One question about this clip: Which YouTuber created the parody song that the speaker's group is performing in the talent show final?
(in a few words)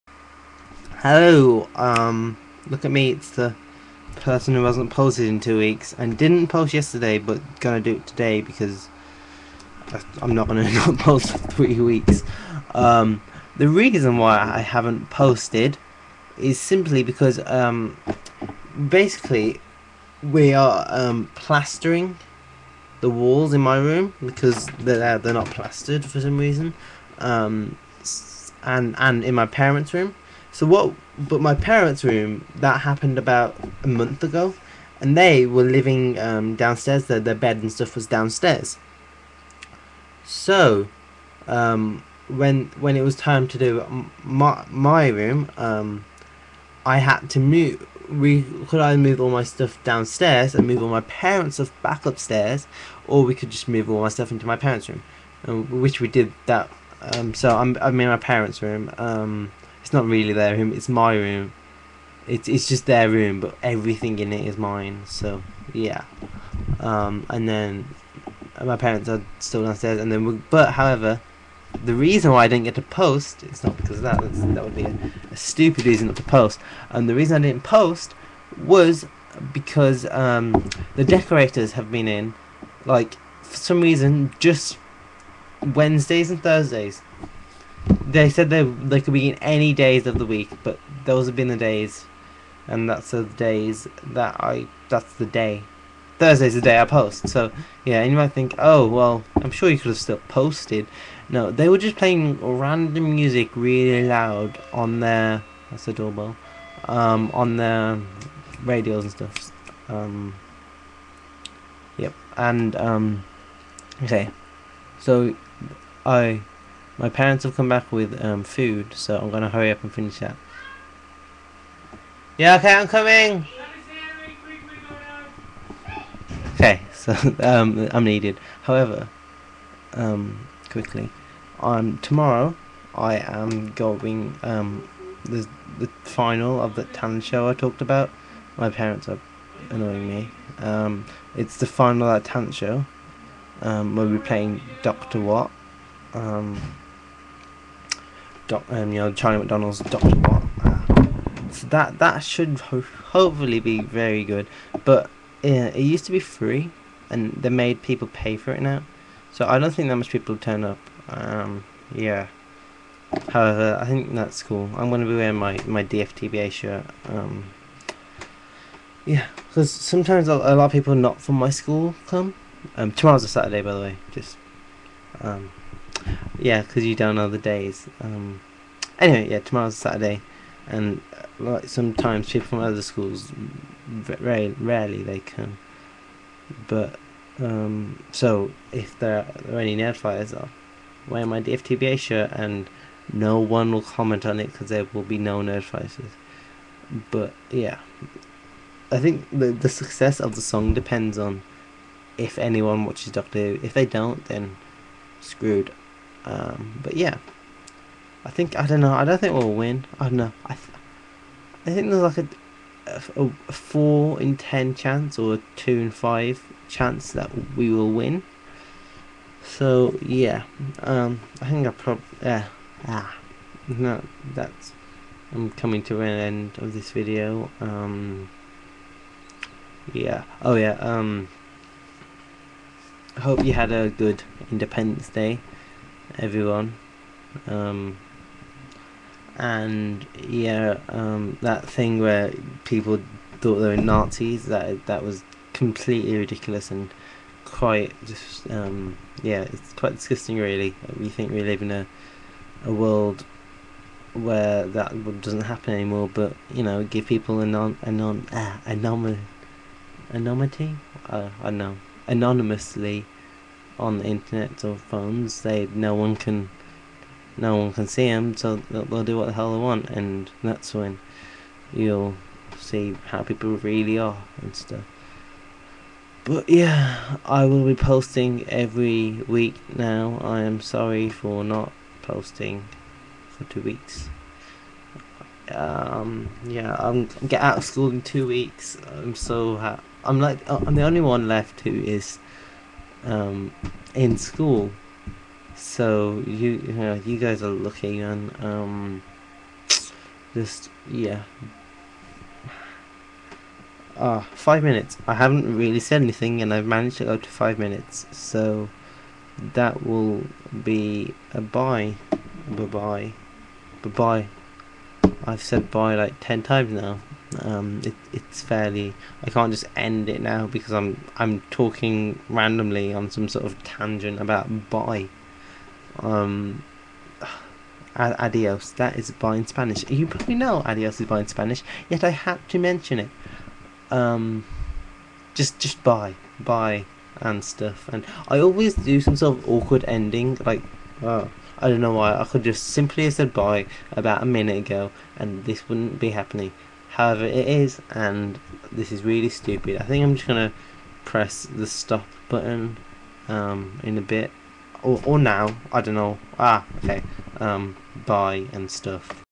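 Charlie McDonnell.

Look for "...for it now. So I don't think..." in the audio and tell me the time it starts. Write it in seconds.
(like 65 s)
158 s.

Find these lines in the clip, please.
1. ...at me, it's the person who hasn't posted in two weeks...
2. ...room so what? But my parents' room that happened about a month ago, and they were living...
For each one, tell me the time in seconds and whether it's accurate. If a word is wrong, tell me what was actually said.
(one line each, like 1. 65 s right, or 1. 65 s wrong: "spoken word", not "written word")
1. 2 s right
2. 29 s right.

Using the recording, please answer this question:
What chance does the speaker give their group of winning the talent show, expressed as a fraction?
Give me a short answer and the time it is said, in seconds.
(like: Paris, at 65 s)
2 in 5, at 215 s.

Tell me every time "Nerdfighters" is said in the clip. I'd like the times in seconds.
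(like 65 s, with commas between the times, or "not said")
189 s, 195 s.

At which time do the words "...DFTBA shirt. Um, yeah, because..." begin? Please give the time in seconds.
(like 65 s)
165 s.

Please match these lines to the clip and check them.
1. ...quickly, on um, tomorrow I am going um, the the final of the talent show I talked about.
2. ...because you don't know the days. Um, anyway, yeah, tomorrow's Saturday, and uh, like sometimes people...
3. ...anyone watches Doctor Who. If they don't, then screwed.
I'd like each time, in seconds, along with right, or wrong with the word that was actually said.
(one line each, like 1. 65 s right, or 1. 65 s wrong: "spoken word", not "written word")
1. 130 s right
2. 176 s right
3. 202 s right.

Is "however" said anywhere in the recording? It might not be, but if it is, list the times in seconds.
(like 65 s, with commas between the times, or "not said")
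70 s, 128 s, 163 s, 346 s.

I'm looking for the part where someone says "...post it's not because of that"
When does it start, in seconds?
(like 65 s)
72 s.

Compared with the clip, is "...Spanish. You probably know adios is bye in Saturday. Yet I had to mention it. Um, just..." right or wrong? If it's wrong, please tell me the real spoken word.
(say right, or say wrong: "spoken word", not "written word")
wrong: "Spanish", not "Saturday".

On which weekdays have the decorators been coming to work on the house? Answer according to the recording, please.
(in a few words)
Wednesdays.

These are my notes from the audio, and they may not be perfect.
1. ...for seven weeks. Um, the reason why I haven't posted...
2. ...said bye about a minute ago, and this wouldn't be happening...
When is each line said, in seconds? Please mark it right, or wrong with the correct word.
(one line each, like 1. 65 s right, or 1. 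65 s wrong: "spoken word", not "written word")
1. 11 s wrong: "three", not "seven"
2. 343 s right.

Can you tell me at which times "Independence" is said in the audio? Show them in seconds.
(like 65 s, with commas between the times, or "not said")
234 s.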